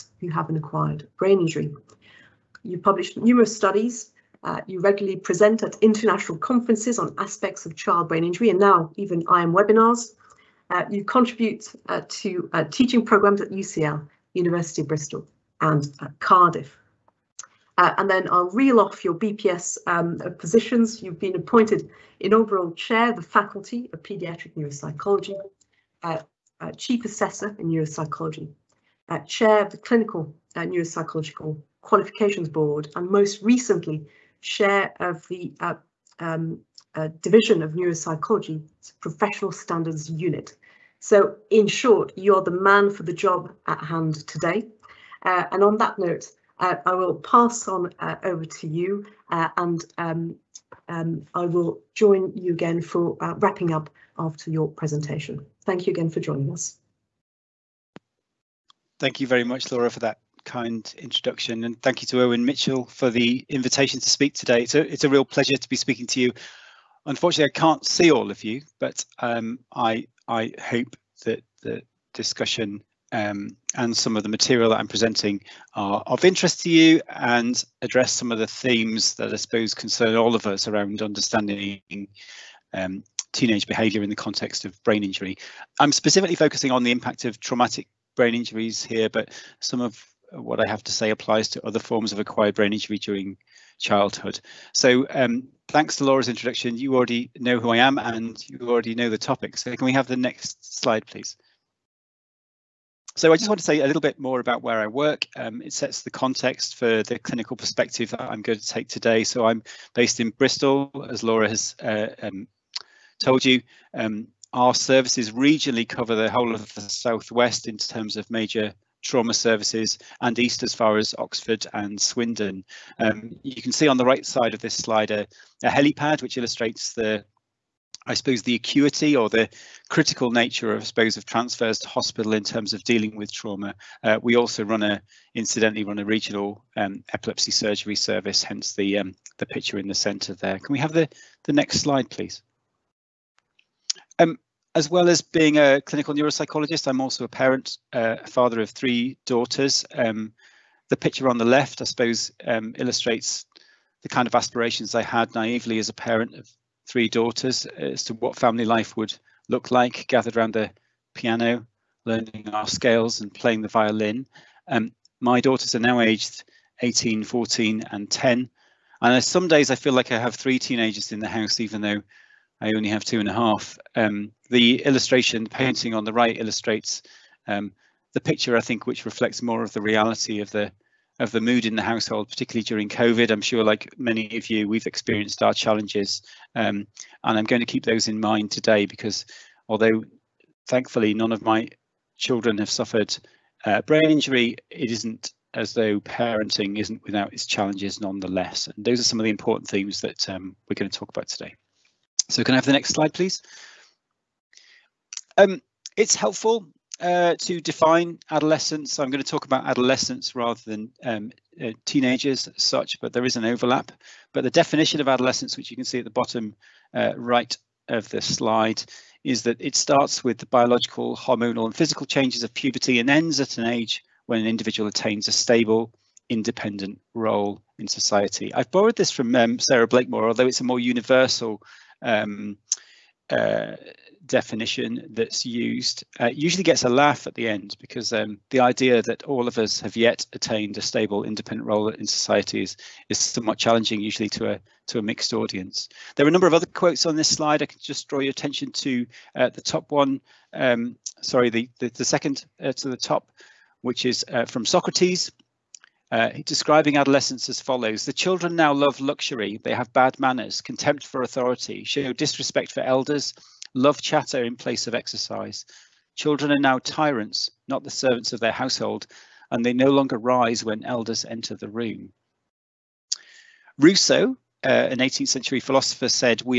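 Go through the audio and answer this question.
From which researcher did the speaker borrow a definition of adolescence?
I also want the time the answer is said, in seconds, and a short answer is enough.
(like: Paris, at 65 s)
Sarah Blakemore, at 229 s.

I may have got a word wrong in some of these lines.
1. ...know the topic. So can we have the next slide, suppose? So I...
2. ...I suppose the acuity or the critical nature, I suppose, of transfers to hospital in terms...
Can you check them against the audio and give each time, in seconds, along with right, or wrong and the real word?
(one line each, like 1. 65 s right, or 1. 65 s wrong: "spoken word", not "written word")
1. 98 s wrong: "please", not "suppose"
2. 128 s right.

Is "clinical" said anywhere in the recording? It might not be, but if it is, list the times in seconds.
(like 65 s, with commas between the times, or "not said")
29 s, 107 s, 145 s.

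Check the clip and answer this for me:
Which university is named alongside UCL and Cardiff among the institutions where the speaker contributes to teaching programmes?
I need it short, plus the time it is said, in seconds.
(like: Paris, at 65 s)
University of Bristol, at 14 s.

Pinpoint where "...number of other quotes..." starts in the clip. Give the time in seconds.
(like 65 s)
246 s.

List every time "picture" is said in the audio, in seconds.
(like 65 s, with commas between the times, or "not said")
139 s, 150 s, 178 s.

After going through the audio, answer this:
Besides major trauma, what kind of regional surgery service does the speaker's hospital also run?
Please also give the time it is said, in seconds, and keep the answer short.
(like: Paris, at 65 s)
Epilepsy surgery, at 137 s.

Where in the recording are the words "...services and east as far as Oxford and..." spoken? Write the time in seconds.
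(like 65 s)
119 s.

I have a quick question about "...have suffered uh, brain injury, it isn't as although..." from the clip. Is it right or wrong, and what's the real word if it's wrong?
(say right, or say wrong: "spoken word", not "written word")
wrong: "though", not "although".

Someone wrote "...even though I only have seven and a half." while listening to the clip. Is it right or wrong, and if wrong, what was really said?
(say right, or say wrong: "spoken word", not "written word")
wrong: "two", not "seven".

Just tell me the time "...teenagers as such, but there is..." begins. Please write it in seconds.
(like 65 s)
211 s.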